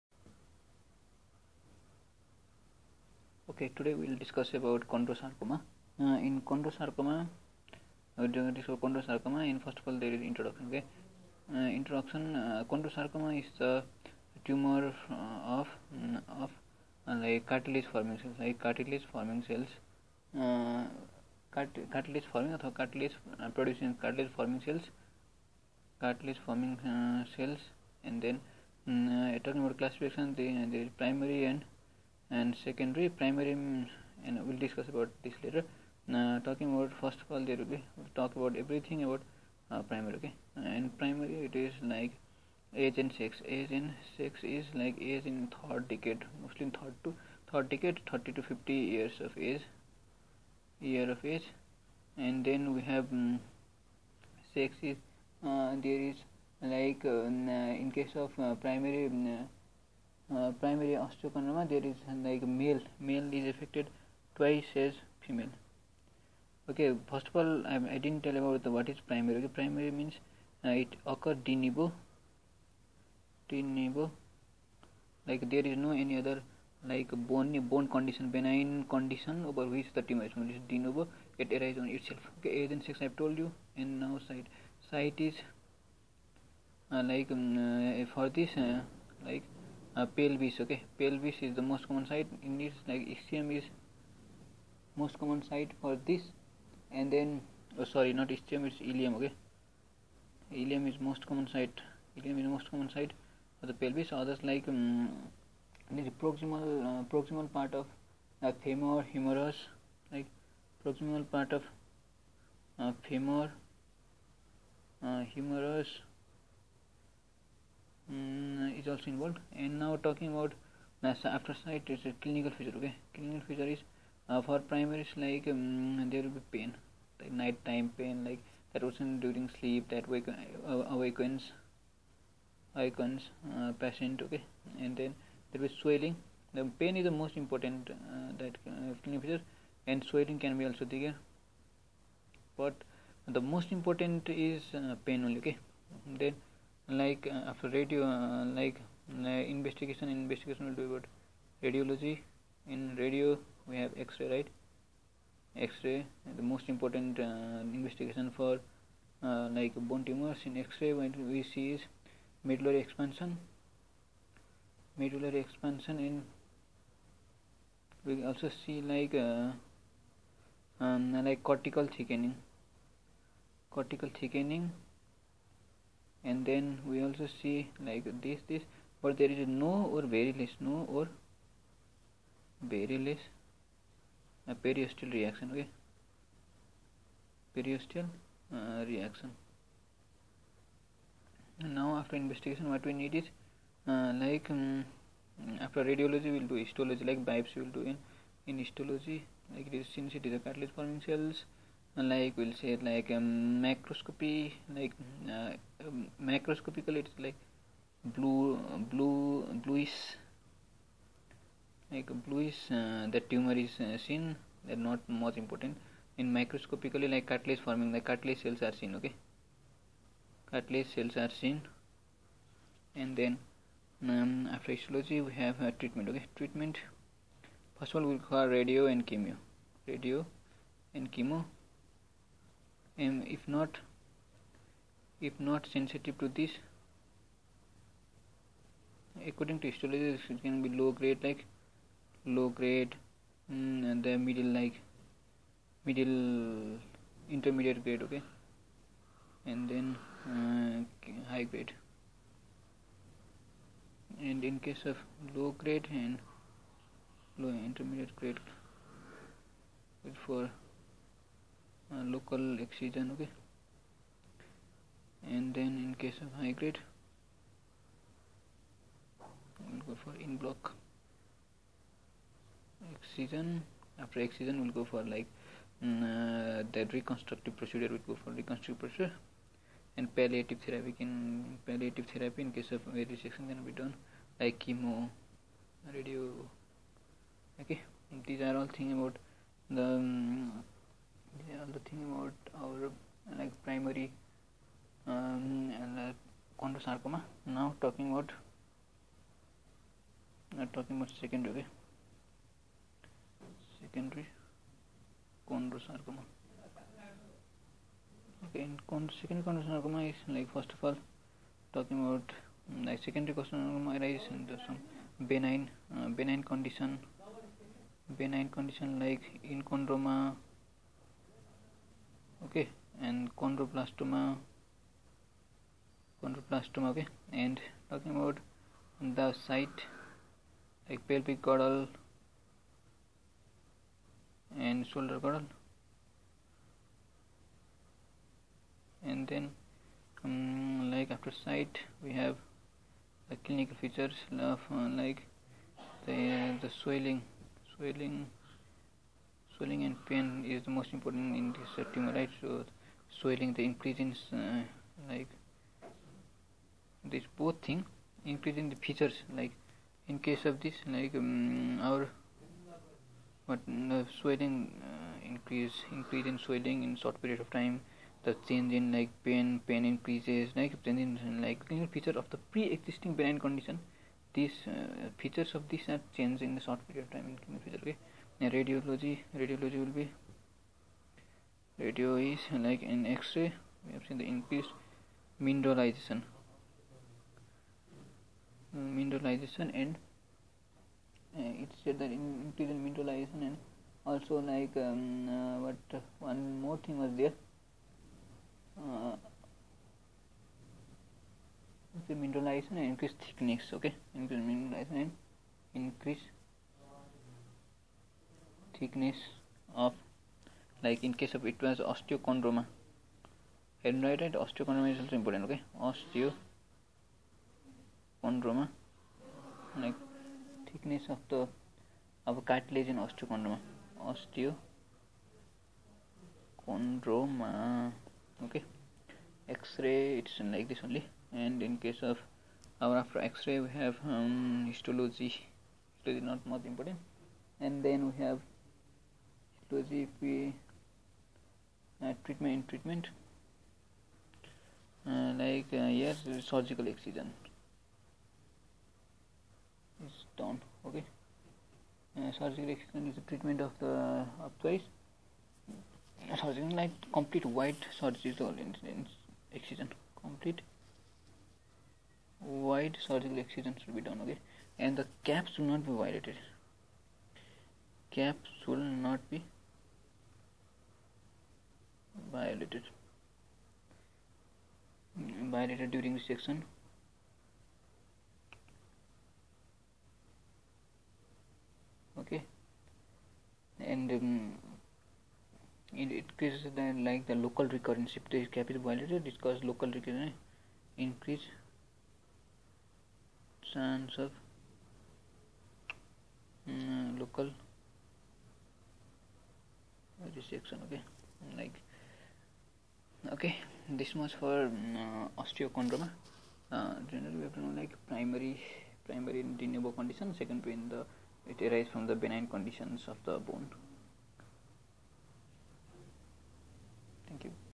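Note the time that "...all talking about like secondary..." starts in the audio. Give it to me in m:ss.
5:10.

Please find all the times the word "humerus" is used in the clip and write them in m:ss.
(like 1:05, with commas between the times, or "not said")
1:49, 1:55.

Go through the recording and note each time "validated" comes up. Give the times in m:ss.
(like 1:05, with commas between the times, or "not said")
7:55, 8:08.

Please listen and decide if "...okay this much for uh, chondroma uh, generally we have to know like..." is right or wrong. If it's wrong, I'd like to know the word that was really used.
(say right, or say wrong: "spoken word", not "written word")
wrong: "osteochondroma", not "chondroma".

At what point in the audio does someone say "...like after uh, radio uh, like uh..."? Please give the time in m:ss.
2:27.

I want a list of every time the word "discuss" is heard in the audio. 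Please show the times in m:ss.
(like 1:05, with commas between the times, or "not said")
0:04, 0:08, 0:34.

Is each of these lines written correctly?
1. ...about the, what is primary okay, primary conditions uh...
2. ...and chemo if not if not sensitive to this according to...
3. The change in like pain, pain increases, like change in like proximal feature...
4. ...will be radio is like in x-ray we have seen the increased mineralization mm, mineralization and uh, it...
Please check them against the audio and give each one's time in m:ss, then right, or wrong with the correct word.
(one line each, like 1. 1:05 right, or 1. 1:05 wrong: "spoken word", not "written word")
1. 1:08 wrong: "means", not "conditions"
2. 3:50 right
3. 6:08 wrong: "clinical", not "proximal"
4. 6:19 right.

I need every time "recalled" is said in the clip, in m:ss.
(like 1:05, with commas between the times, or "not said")
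not said.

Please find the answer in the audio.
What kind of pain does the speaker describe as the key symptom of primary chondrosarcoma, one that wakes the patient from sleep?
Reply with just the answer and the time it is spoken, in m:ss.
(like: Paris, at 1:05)
Night time pain, at 2:07.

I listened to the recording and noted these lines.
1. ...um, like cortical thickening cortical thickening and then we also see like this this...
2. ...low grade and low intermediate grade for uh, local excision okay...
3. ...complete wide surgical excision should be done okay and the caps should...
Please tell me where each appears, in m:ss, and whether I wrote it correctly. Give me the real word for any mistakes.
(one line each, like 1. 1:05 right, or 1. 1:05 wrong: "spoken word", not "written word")
1. 2:50 right
2. 4:15 right
3. 7:40 right.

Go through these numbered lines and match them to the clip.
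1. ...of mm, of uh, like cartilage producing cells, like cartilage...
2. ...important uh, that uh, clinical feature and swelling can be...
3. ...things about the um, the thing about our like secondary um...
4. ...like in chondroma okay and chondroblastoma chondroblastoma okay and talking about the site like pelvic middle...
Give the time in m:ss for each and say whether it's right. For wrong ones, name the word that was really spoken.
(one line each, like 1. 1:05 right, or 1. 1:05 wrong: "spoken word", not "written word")
1. 0:15 wrong: "forming", not "producing"
2. 2:17 right
3. 4:48 wrong: "primary", not "secondary"
4. 5:18 wrong: "girdle", not "middle".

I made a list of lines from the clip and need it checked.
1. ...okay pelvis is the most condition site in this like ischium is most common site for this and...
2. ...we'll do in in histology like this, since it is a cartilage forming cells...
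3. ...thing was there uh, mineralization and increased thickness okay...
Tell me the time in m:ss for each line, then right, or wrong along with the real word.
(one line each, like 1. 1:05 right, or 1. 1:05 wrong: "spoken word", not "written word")
1. 1:30 wrong: "common", not "condition"
2. 3:17 right
3. 6:36 right.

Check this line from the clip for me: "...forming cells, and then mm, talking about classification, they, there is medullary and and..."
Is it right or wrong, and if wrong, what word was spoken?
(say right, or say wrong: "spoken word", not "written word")
wrong: "primary", not "medullary".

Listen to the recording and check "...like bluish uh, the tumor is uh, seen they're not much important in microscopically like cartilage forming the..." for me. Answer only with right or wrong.
right.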